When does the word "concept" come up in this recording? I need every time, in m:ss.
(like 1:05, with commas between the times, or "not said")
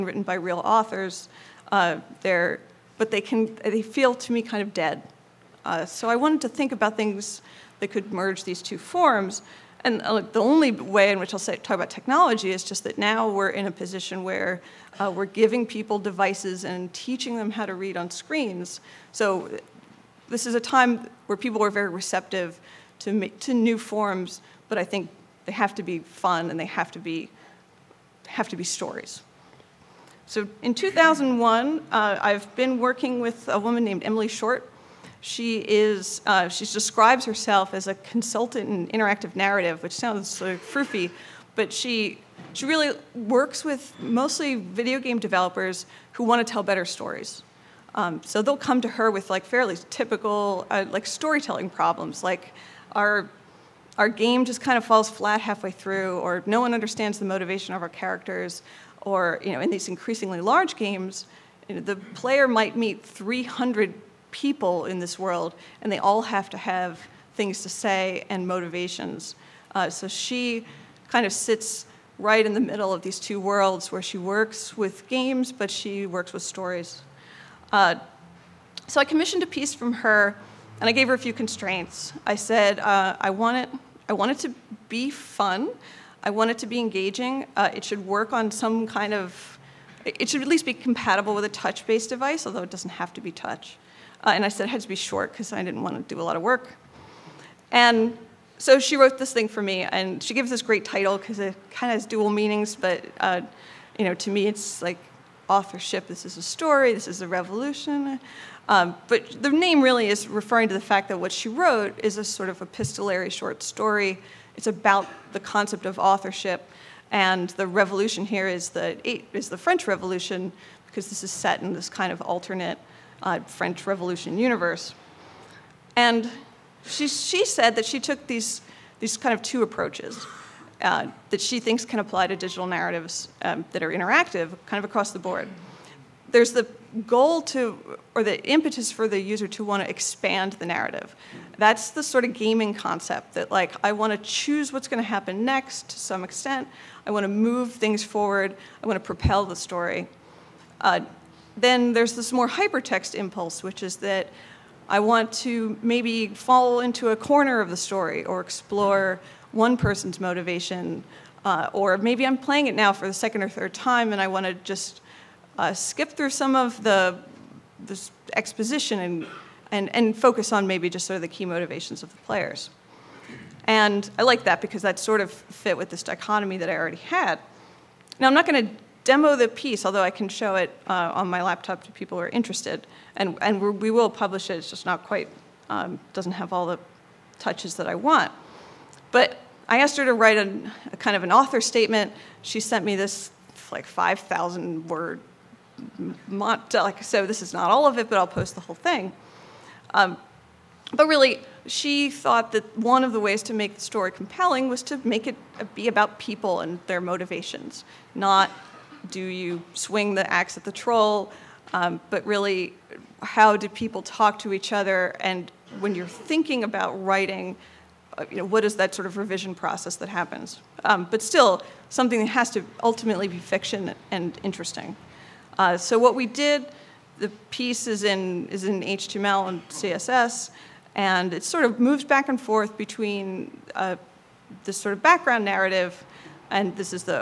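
1:55, 2:22.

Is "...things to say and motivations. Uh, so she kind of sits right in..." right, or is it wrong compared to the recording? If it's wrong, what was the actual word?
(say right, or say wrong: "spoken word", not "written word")
right.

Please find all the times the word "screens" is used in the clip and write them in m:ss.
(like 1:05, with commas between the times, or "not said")
0:18.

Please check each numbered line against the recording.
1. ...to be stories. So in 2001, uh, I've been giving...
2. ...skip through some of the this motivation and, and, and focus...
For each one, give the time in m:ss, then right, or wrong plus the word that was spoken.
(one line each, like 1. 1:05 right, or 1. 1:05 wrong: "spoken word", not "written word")
1. 0:28 wrong: "working", not "giving"
2. 2:45 wrong: "exposition", not "motivation".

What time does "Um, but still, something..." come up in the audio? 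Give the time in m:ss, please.
3:40.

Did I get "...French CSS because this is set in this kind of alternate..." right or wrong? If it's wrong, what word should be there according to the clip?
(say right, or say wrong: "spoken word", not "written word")
wrong: "Revolution", not "CSS".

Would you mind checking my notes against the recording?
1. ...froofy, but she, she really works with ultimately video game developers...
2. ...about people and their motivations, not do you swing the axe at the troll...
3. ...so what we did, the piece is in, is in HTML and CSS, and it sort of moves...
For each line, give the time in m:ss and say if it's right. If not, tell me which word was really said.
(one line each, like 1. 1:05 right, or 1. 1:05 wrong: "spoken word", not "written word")
1. 0:40 wrong: "mostly", not "ultimately"
2. 3:25 right
3. 3:45 right.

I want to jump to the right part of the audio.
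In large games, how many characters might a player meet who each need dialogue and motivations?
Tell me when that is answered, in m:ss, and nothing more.
1:03.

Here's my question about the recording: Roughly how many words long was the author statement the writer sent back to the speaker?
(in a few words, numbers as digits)
5,000.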